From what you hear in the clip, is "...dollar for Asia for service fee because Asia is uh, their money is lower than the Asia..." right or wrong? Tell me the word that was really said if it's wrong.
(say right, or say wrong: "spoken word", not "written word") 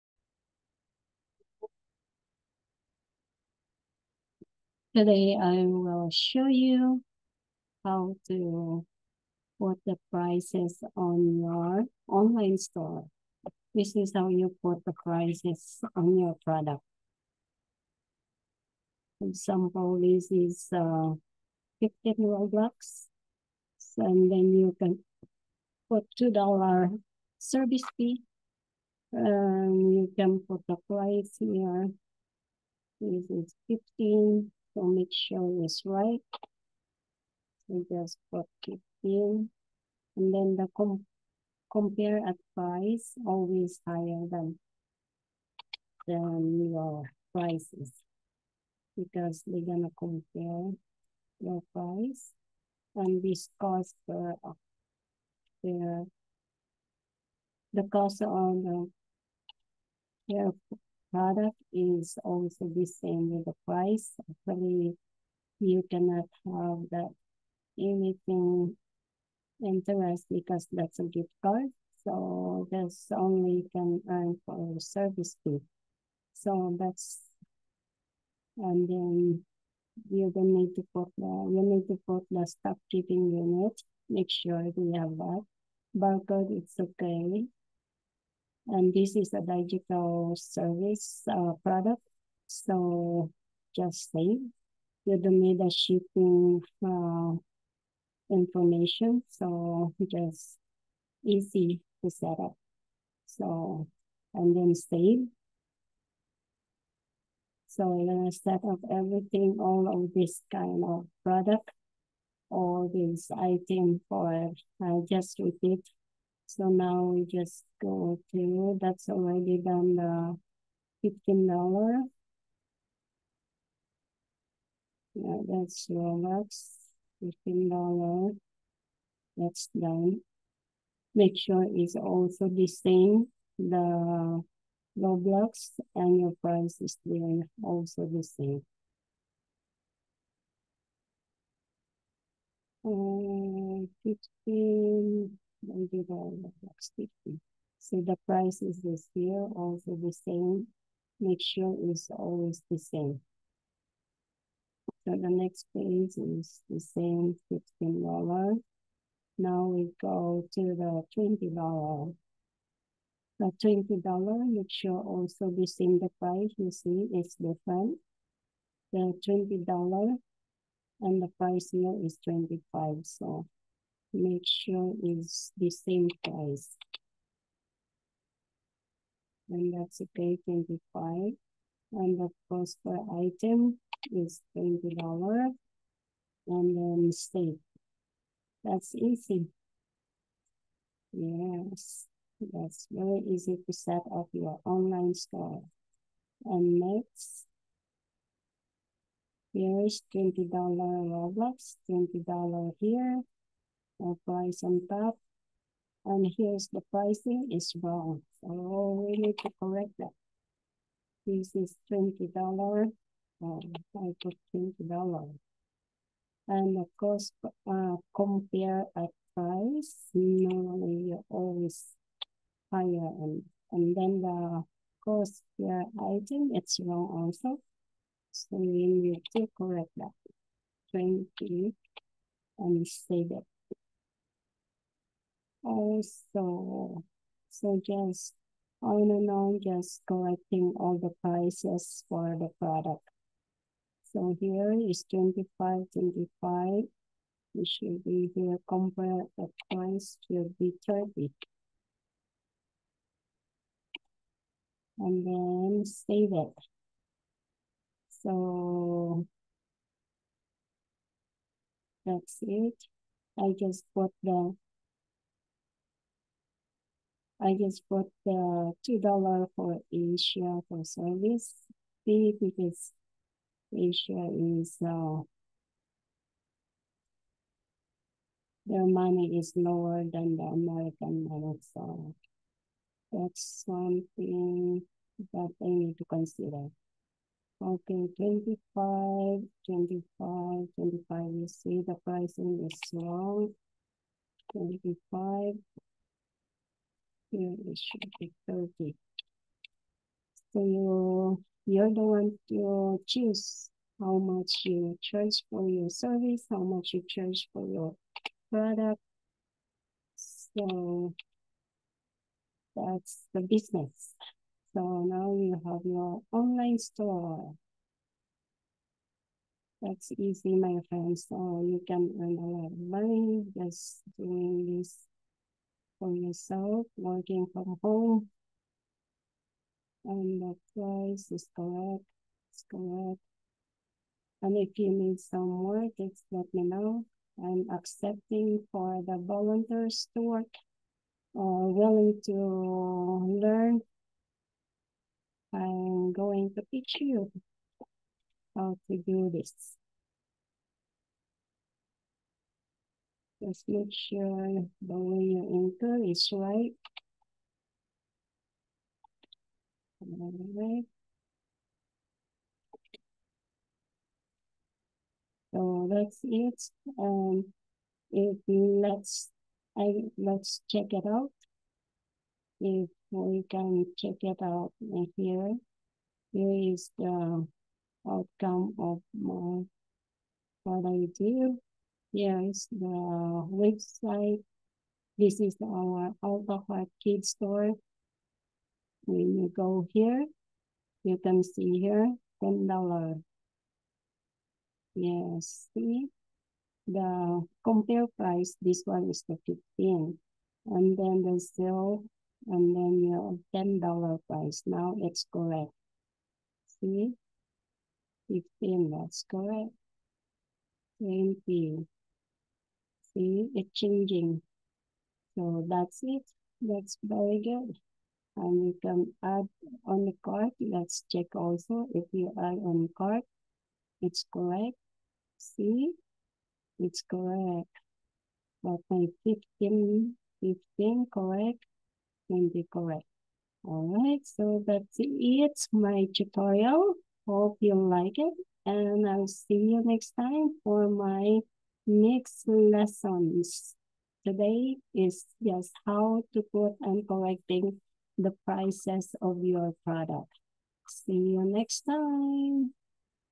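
wrong: "American", not "Asia".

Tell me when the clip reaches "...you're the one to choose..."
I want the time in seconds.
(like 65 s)
301 s.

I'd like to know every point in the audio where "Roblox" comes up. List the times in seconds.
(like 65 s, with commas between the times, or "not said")
125 s, 134 s, 200 s.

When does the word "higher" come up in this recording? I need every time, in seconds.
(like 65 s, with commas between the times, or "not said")
43 s, 222 s.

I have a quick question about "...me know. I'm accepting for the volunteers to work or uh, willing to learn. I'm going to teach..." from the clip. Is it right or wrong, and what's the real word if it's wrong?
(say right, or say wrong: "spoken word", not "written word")
right.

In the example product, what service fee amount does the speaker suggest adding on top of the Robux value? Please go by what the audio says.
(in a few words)
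$2.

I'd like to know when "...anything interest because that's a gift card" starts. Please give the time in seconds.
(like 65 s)
67 s.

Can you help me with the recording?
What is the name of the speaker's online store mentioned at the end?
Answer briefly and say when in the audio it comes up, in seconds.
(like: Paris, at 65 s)
Alpha kids store, at 386 s.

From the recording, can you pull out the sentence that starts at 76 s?
So that's and then you don't need to put the you need to put the stock keeping unit.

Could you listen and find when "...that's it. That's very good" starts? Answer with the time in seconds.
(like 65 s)
415 s.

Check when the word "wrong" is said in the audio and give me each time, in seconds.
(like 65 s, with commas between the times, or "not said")
207 s, 226 s, 292 s.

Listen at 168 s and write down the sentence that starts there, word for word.
The $20 and the price here is 25, so make sure it's the same price.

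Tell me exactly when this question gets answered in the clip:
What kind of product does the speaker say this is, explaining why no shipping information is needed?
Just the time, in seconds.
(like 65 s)
89 s.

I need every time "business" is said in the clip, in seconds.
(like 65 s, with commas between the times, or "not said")
313 s.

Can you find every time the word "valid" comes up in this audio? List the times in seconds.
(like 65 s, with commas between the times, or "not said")
not said.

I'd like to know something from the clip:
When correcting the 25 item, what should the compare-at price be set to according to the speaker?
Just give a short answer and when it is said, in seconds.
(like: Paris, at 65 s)
30, at 248 s.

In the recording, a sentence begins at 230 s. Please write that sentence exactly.
20 and save it also oh, so just on and on just collecting all the prices for the product.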